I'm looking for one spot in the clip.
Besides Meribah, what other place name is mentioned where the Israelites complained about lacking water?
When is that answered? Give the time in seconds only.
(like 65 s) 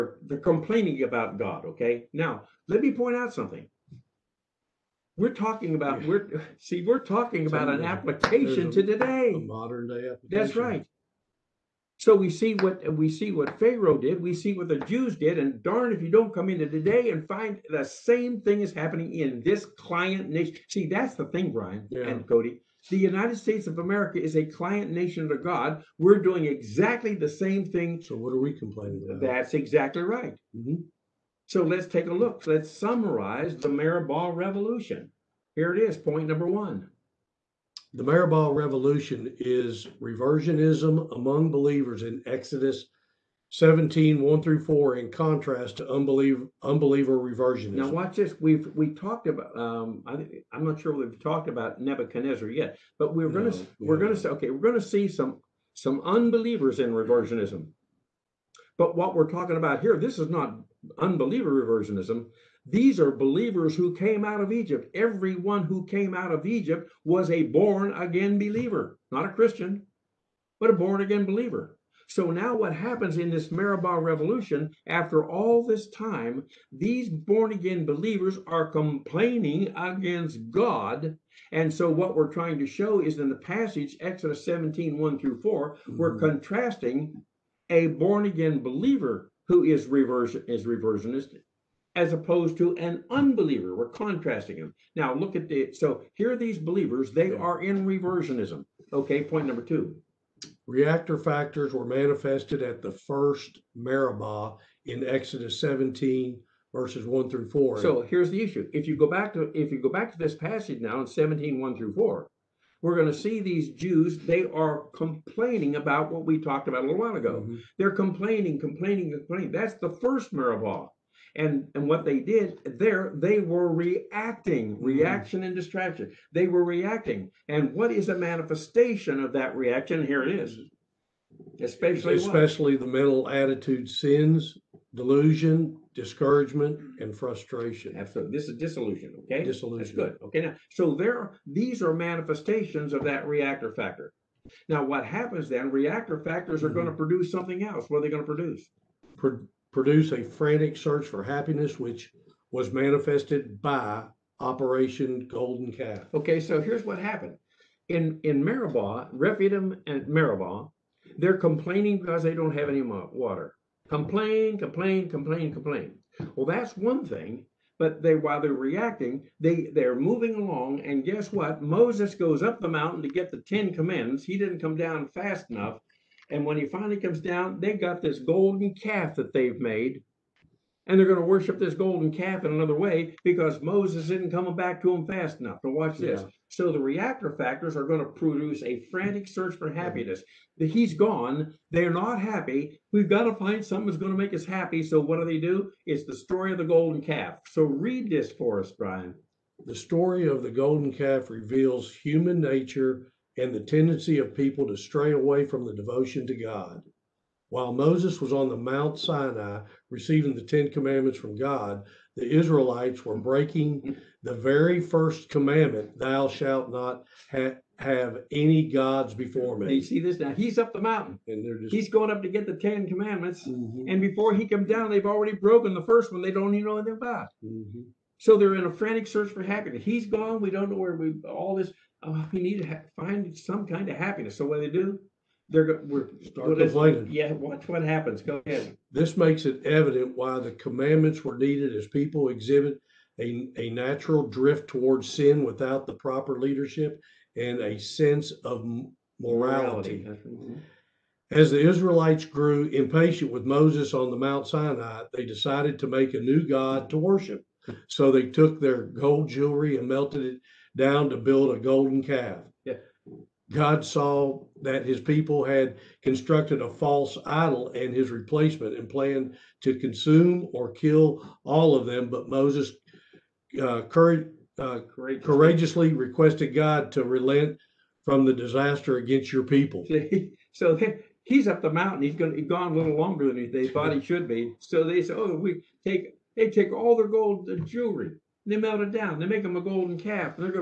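159 s.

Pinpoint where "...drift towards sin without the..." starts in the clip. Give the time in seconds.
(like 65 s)
244 s.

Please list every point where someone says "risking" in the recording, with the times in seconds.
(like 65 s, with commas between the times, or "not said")
not said.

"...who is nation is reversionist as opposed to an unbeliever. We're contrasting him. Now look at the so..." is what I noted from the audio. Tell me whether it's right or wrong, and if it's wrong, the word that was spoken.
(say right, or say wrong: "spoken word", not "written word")
wrong: "reversion", not "nation".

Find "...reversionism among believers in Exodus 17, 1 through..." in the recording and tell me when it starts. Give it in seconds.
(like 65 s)
40 s.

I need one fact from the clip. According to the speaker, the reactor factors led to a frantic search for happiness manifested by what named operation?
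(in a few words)
Operation Golden Calf.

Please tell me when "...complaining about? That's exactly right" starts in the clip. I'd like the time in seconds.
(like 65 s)
28 s.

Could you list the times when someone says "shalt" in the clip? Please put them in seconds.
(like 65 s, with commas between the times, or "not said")
216 s.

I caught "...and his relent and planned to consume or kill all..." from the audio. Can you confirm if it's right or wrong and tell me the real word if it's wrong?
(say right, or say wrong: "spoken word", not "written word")
wrong: "replacement", not "relent".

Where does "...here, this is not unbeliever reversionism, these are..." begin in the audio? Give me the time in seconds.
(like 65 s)
59 s.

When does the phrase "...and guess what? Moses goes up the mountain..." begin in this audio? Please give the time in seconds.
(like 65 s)
170 s.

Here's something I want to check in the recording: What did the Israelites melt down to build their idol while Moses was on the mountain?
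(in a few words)
gold jewelry.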